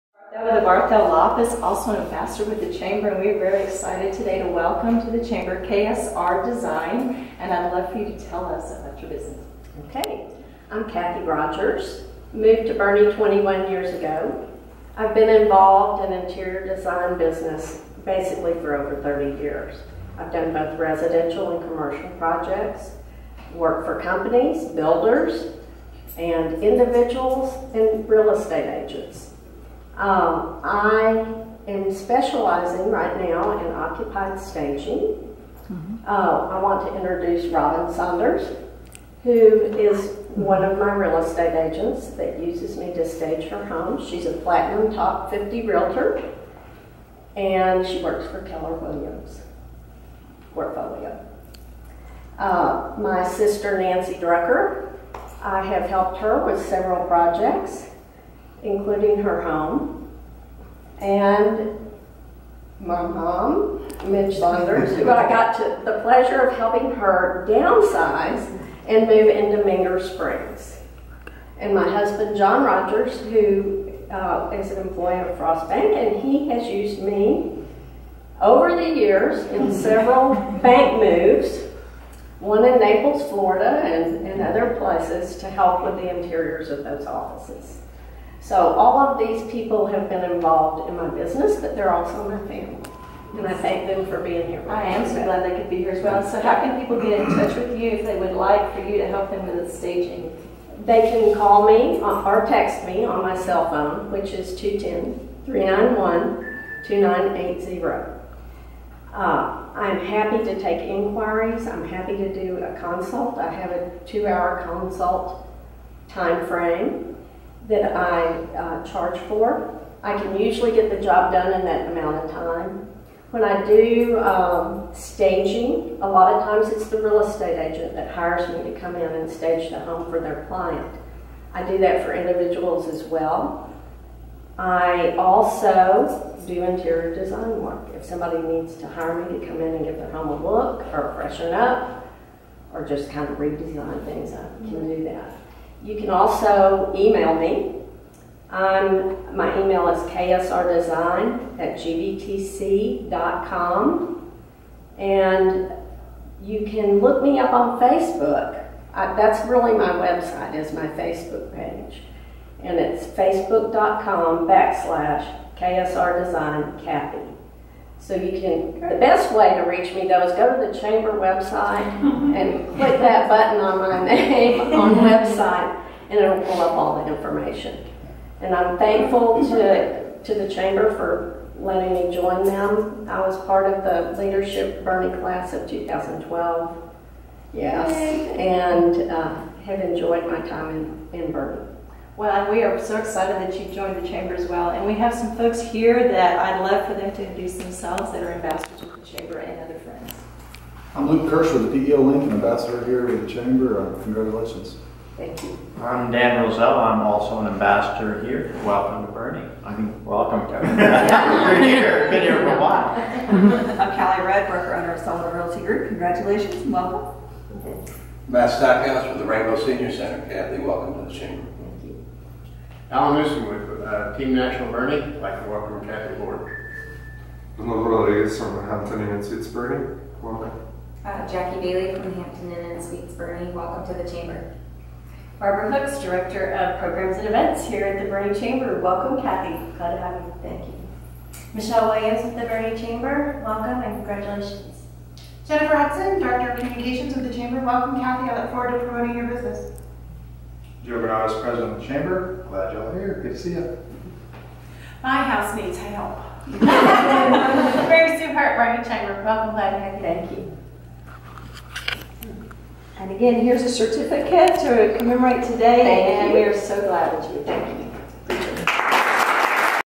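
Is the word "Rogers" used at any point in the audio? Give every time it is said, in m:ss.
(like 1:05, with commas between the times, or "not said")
0:11, 1:12.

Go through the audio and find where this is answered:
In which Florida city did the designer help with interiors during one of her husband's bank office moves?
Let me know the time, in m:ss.
1:22.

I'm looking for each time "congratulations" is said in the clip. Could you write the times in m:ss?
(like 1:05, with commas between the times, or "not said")
3:24, 3:35, 4:04.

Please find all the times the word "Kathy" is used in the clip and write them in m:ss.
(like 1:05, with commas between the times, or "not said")
0:10, 2:46, 3:40, 3:45, 3:59, 4:08.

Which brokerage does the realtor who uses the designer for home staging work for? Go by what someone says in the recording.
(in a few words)
Keller Williams Portfolio.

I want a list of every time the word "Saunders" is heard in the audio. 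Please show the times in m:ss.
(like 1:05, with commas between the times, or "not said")
0:37, 1:04.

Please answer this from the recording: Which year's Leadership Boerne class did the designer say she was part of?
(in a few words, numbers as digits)
2012.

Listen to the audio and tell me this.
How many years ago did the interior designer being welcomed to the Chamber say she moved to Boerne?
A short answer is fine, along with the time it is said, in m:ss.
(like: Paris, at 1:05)
21, at 0:13.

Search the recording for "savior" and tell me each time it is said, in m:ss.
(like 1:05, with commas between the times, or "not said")
not said.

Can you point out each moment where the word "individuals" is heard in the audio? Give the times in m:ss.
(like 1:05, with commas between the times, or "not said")
0:26, 2:12.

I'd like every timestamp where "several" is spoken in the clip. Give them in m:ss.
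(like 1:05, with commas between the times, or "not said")
0:56, 1:19.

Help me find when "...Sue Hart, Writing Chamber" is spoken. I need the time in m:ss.
4:18.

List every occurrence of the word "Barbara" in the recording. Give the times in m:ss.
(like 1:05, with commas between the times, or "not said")
3:55.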